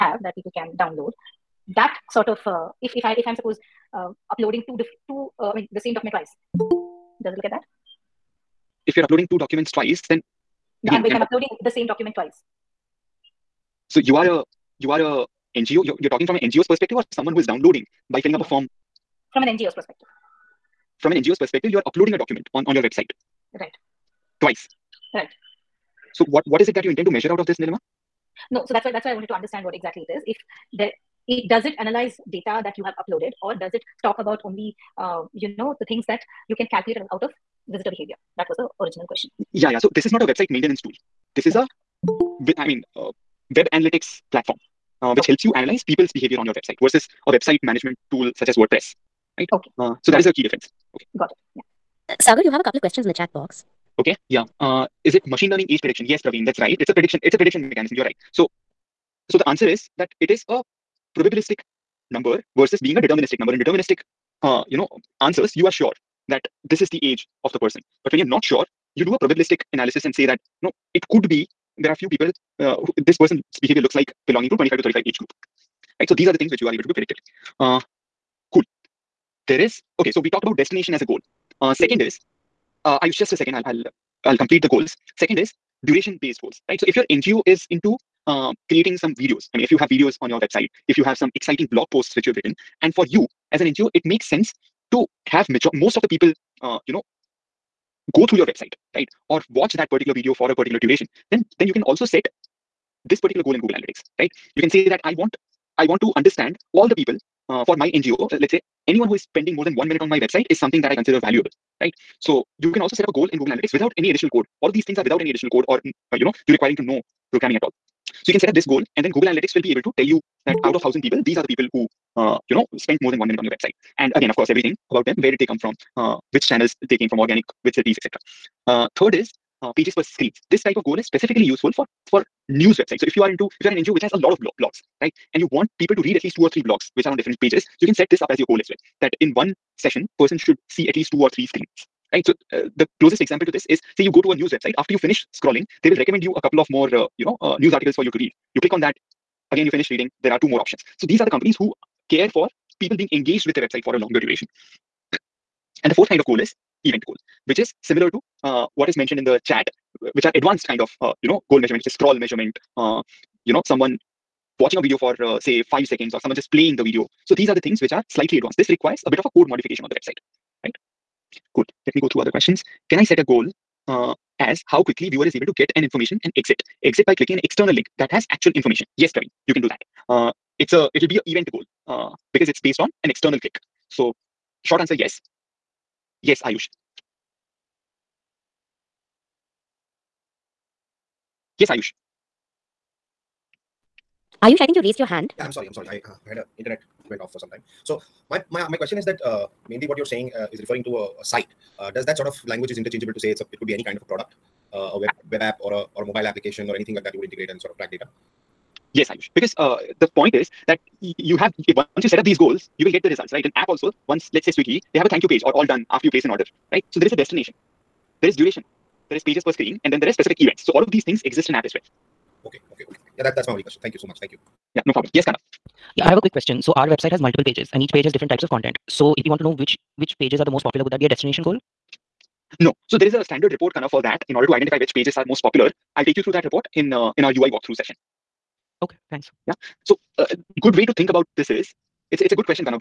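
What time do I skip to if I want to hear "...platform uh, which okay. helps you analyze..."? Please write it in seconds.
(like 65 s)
44 s.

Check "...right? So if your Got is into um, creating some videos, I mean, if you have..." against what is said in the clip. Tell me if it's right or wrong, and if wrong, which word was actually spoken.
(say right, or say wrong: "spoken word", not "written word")
wrong: "NGO", not "Got".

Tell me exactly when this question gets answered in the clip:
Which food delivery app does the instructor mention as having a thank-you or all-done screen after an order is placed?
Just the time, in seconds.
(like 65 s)
214 s.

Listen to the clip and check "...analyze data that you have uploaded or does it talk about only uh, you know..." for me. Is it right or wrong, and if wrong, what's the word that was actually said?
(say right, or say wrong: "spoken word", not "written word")
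right.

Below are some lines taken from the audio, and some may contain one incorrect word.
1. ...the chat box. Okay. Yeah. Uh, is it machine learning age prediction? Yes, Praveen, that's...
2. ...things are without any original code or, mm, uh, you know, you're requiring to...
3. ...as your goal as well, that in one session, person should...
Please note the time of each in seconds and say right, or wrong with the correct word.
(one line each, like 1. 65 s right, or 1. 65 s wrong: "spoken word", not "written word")
1. 53 s right
2. 114 s wrong: "additional", not "original"
3. 138 s right.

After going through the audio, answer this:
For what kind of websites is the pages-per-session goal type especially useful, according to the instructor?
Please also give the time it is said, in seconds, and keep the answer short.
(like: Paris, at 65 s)
news websites, at 132 s.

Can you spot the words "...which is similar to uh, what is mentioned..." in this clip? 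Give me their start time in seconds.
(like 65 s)
157 s.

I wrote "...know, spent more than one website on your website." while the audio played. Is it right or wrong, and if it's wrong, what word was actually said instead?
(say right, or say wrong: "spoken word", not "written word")
wrong: "minute", not "website".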